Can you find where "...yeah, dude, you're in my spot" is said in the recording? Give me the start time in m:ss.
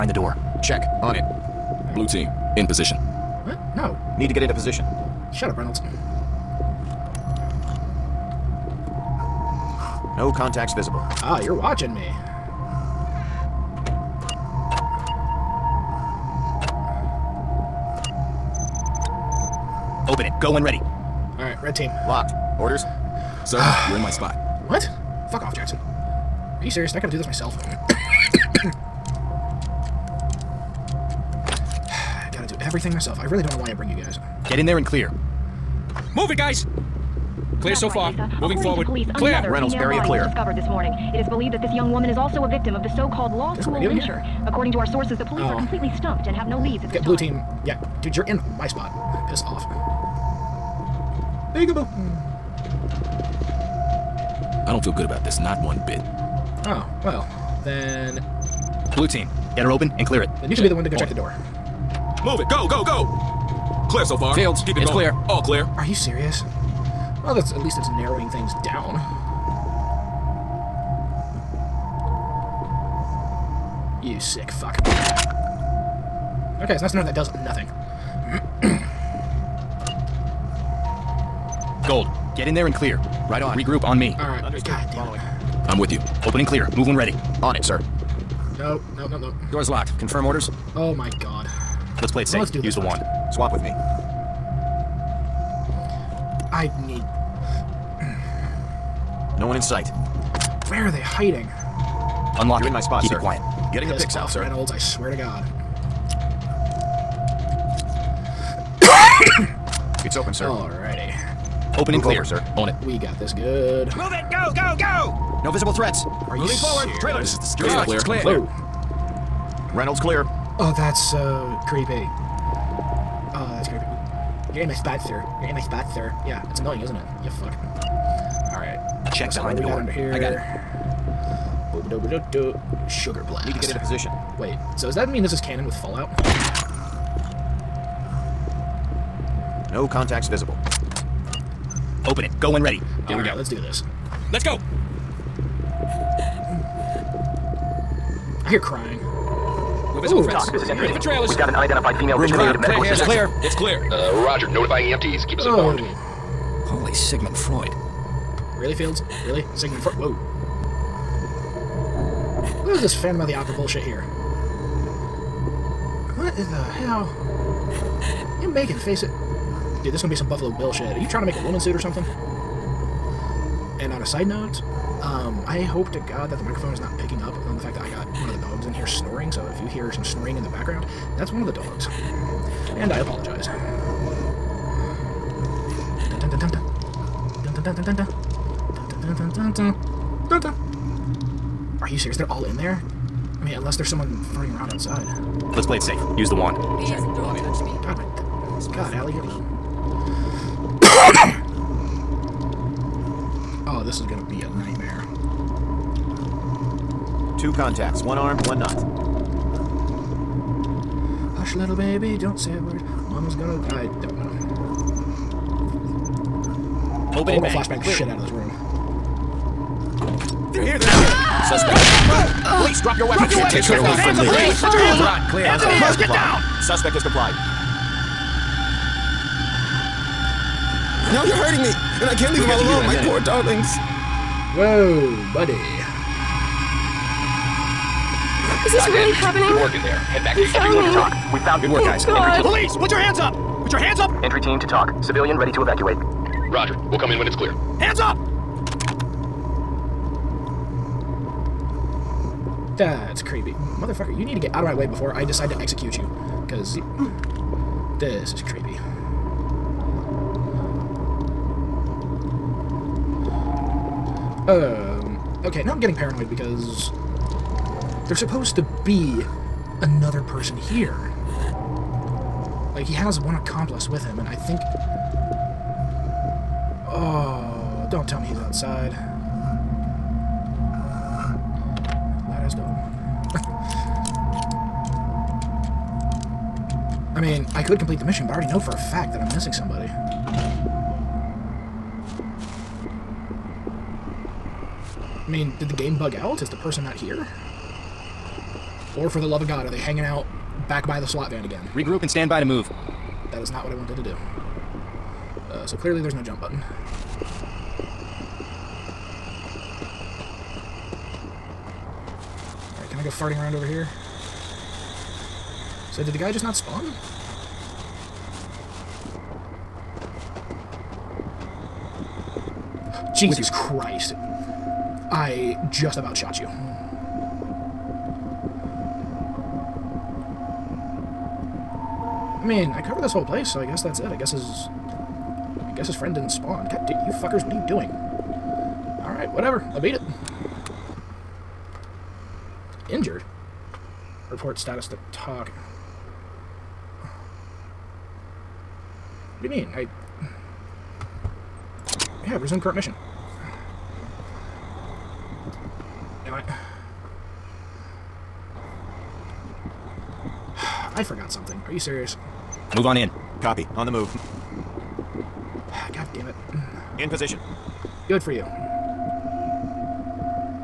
0:47.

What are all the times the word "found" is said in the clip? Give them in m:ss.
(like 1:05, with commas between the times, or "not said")
2:31, 4:01.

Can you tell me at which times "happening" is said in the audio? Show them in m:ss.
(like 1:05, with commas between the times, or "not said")
3:59.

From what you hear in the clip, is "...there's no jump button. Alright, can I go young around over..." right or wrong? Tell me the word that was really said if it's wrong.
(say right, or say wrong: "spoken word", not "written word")
wrong: "farting", not "young".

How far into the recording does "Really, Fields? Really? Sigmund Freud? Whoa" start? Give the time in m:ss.
2:38.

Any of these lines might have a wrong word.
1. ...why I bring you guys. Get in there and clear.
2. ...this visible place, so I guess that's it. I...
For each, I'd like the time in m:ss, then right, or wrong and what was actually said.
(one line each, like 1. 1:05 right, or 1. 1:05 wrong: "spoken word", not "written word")
1. 0:33 right
2. 5:33 wrong: "whole", not "visible".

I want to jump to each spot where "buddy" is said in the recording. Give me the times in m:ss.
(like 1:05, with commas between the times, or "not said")
3:55.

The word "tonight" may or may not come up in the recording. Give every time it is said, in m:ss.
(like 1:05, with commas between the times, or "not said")
not said.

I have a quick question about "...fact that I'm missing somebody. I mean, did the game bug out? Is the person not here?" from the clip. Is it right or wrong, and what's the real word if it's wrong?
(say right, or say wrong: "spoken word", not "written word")
right.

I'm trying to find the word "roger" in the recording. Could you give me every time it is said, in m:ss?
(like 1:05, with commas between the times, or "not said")
2:34, 4:05.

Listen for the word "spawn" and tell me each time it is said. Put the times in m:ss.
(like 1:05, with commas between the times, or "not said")
5:16, 5:36.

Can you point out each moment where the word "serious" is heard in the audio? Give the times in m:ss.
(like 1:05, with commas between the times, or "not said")
0:26, 1:05, 3:11, 6:01.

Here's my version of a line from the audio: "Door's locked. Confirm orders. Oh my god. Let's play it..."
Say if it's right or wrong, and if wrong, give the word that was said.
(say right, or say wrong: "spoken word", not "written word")
right.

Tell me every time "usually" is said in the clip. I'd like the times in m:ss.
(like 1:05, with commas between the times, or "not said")
not said.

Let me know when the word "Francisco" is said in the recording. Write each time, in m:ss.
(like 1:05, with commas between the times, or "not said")
not said.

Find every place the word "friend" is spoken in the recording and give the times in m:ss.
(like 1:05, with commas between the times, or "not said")
5:35.